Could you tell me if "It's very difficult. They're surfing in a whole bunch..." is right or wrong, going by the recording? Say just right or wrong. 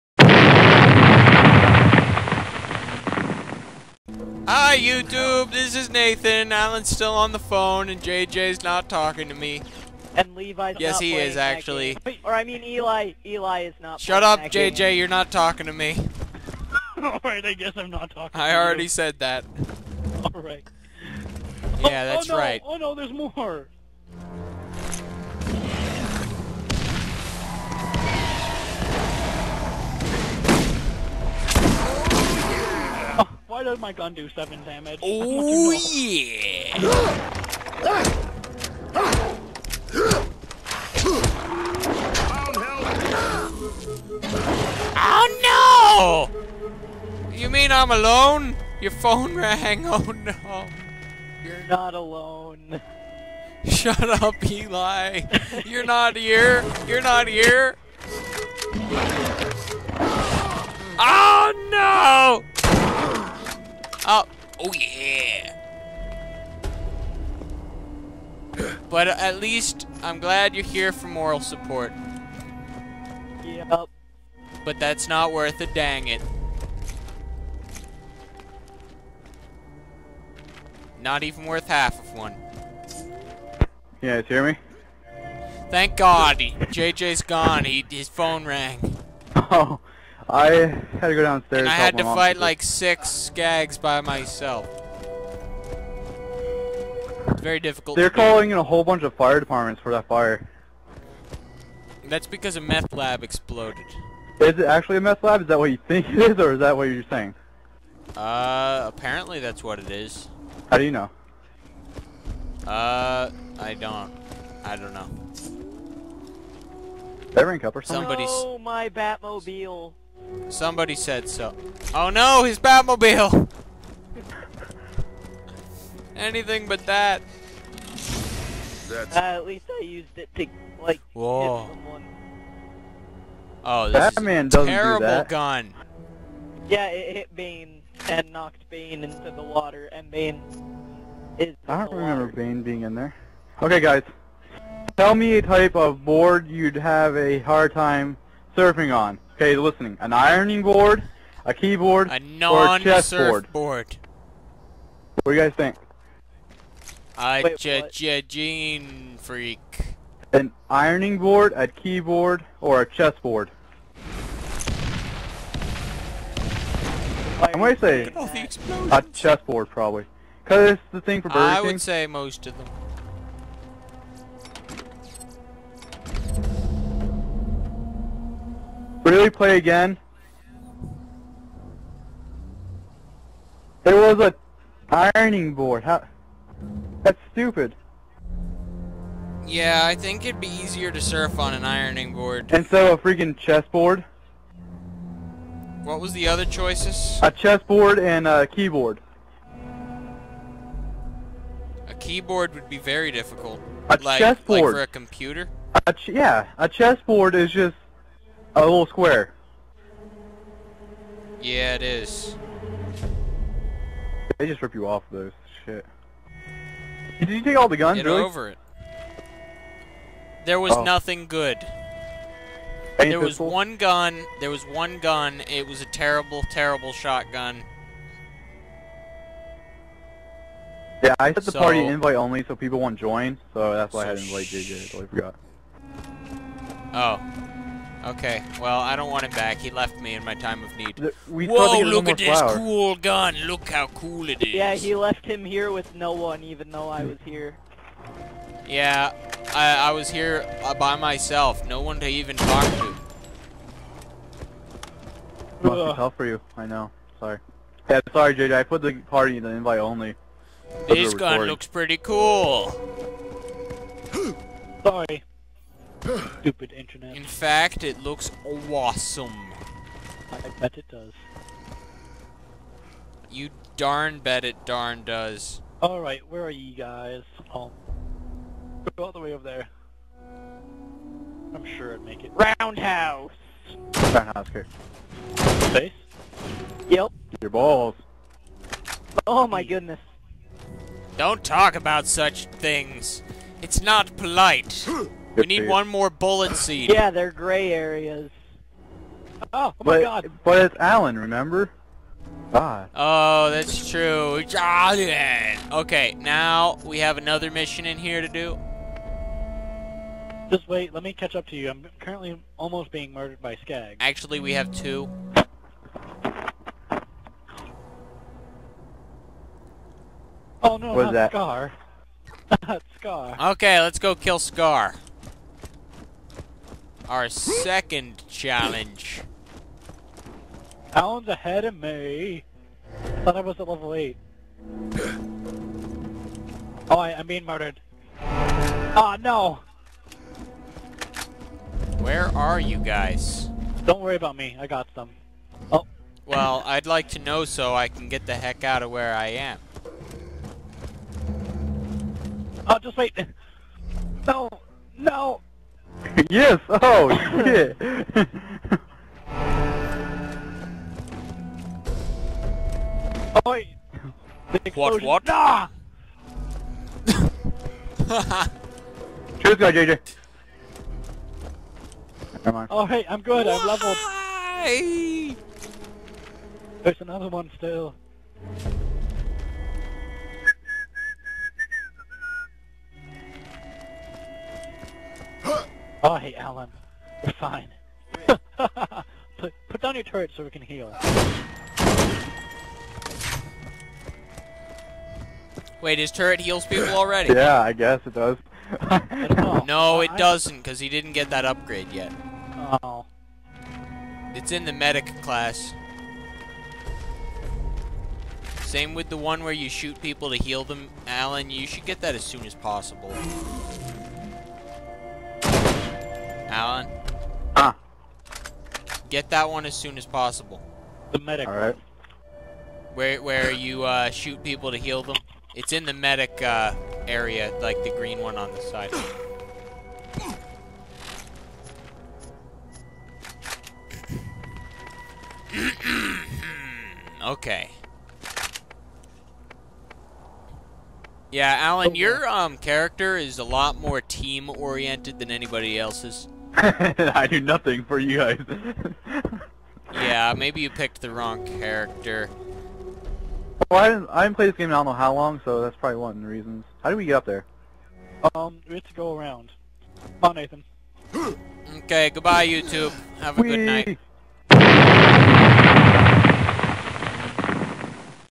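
wrong.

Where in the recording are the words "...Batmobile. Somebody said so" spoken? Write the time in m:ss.
1:58.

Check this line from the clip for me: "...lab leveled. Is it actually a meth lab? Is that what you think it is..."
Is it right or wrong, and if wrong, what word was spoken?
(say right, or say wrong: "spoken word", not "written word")
wrong: "exploded", not "leveled".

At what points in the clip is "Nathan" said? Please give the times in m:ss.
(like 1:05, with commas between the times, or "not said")
0:05, 7:40.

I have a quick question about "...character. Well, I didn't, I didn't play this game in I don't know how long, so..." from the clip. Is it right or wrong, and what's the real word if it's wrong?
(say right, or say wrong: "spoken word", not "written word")
right.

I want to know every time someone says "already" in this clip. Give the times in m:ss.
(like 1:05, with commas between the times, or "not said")
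0:18, 6:36.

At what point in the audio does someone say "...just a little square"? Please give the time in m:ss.
3:27.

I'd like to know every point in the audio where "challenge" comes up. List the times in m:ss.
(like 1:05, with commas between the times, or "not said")
5:28.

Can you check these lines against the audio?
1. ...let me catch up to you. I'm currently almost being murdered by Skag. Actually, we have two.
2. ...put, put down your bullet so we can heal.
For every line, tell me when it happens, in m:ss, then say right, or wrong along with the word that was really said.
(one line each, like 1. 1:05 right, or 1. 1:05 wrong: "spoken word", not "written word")
1. 5:10 right
2. 6:29 wrong: "turret", not "bullet".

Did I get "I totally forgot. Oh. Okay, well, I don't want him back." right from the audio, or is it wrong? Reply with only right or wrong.
right.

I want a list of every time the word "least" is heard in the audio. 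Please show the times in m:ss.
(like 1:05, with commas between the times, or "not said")
1:09, 2:09.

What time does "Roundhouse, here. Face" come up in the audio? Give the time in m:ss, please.
4:43.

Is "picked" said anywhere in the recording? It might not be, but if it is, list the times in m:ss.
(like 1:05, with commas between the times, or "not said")
7:30.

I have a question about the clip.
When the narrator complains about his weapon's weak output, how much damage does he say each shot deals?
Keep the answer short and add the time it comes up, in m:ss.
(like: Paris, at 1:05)
7, at 0:34.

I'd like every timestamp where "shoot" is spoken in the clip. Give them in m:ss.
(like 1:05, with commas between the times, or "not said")
6:49, 7:04.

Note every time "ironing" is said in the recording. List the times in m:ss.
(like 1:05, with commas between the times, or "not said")
2:30, 2:40, 3:04, 3:11.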